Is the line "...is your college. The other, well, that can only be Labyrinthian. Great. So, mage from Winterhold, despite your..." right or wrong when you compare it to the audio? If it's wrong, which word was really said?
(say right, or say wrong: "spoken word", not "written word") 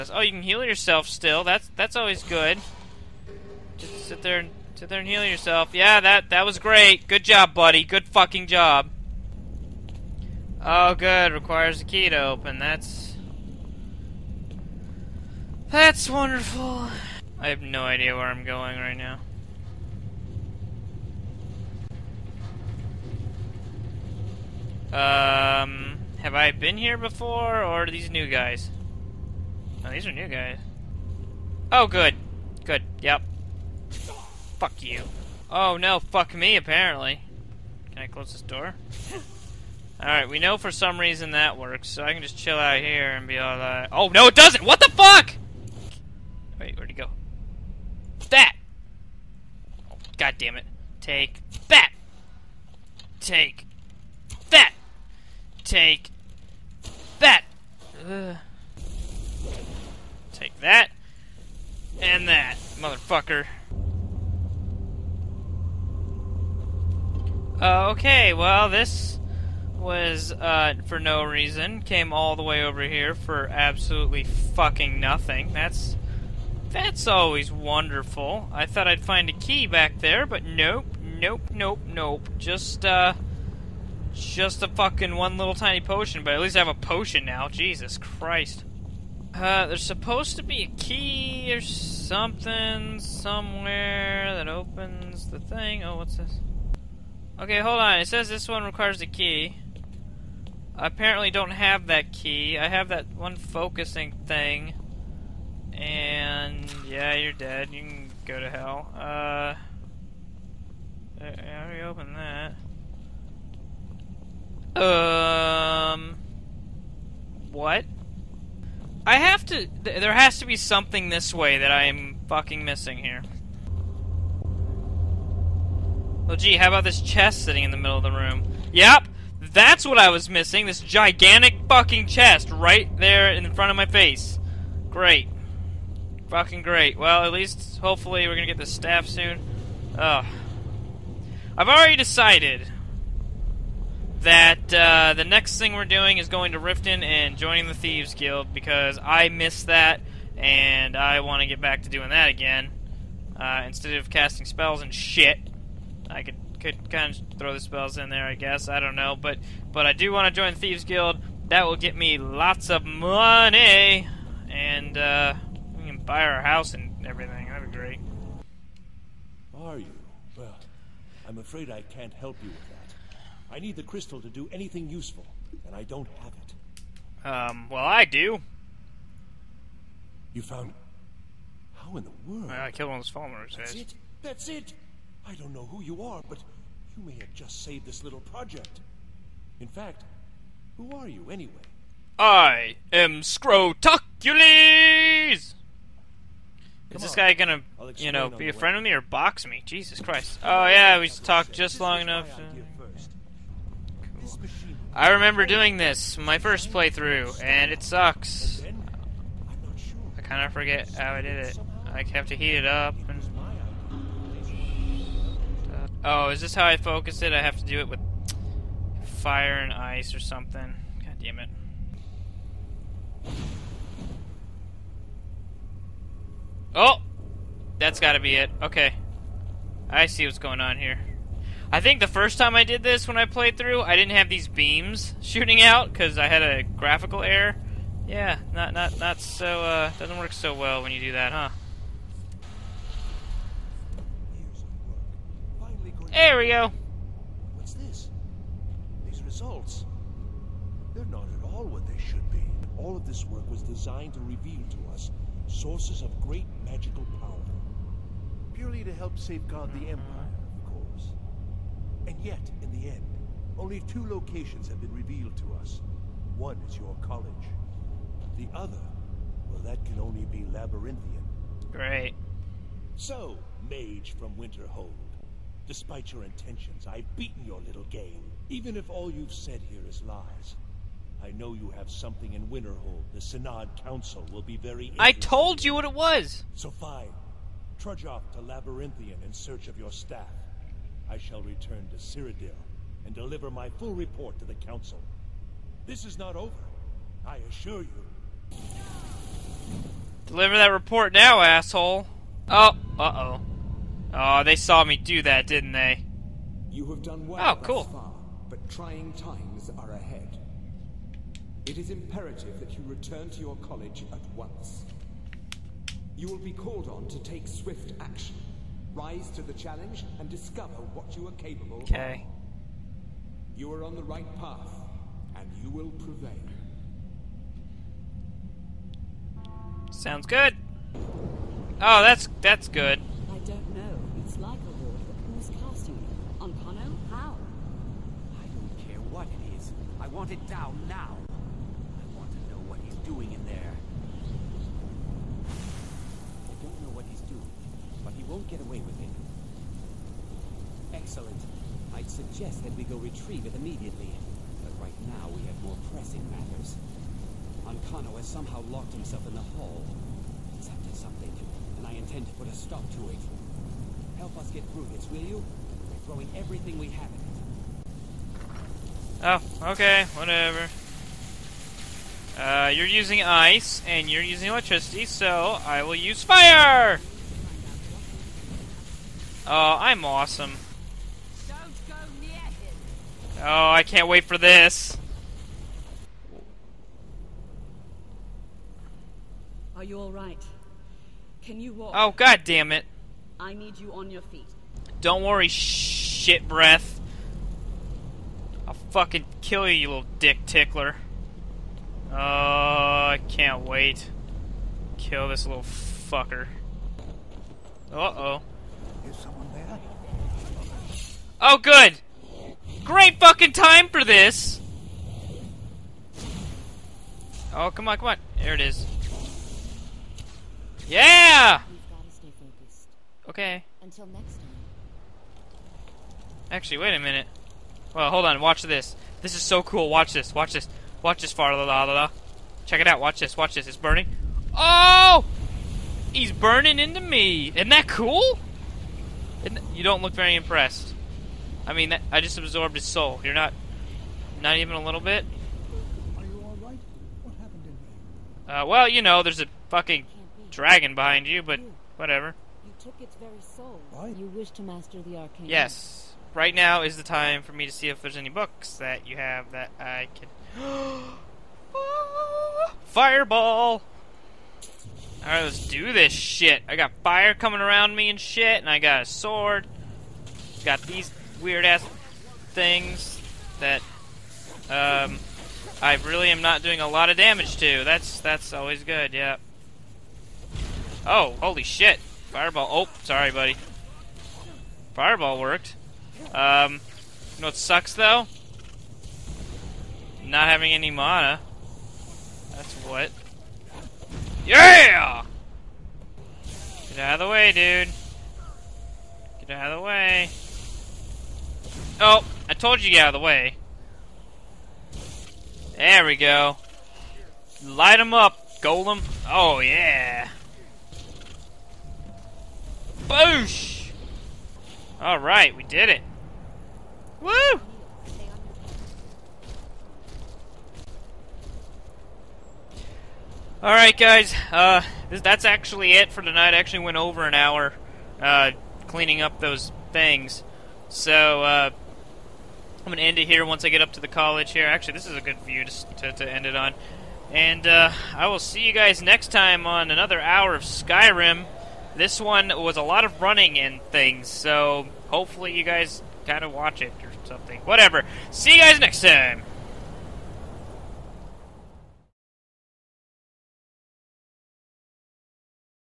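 right.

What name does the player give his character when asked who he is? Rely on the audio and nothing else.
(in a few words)
Scrotocules.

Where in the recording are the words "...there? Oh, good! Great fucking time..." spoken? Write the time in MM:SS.
06:49.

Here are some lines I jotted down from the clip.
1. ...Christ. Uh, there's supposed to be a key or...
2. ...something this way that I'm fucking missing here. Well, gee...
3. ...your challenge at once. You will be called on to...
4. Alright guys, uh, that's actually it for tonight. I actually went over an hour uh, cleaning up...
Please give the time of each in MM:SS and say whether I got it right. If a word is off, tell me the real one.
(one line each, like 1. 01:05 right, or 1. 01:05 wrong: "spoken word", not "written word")
1. 01:27 right
2. 02:00 right
3. 05:13 wrong: "college", not "challenge"
4. 08:43 right.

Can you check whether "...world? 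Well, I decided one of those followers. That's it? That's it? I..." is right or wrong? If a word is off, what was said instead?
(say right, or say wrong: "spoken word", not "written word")
wrong: "killed", not "decided".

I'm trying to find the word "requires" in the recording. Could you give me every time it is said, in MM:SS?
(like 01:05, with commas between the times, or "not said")
00:11, 01:38.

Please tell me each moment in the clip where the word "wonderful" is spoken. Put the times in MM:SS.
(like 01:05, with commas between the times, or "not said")
00:16, 01:17.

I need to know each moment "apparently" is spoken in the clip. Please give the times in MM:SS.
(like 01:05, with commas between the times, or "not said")
00:36, 01:40.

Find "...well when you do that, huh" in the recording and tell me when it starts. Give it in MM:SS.
04:00.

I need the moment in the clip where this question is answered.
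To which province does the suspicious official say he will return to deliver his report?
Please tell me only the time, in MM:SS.
04:51.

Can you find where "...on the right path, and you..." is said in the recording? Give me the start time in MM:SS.
05:23.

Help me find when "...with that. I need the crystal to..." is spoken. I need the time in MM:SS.
02:52.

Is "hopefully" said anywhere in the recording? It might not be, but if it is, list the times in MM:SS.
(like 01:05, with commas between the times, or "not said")
02:17, 09:05.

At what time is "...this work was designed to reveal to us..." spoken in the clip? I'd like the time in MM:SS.
04:13.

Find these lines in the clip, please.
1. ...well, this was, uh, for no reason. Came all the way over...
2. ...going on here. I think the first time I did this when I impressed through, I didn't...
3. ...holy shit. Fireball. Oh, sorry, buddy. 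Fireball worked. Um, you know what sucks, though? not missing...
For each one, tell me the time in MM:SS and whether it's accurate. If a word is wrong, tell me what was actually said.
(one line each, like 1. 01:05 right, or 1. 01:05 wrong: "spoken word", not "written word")
1. 01:08 right
2. 03:50 wrong: "played", not "impressed"
3. 08:01 wrong: "having", not "missing".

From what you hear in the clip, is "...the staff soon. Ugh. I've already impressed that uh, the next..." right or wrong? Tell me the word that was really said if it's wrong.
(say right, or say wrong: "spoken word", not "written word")
wrong: "decided", not "impressed".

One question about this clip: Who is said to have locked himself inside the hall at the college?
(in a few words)
Ancano.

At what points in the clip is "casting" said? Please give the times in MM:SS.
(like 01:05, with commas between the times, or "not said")
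02:34, 05:35.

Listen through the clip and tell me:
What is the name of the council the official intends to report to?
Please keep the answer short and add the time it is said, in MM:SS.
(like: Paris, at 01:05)
Synod Council, at 04:43.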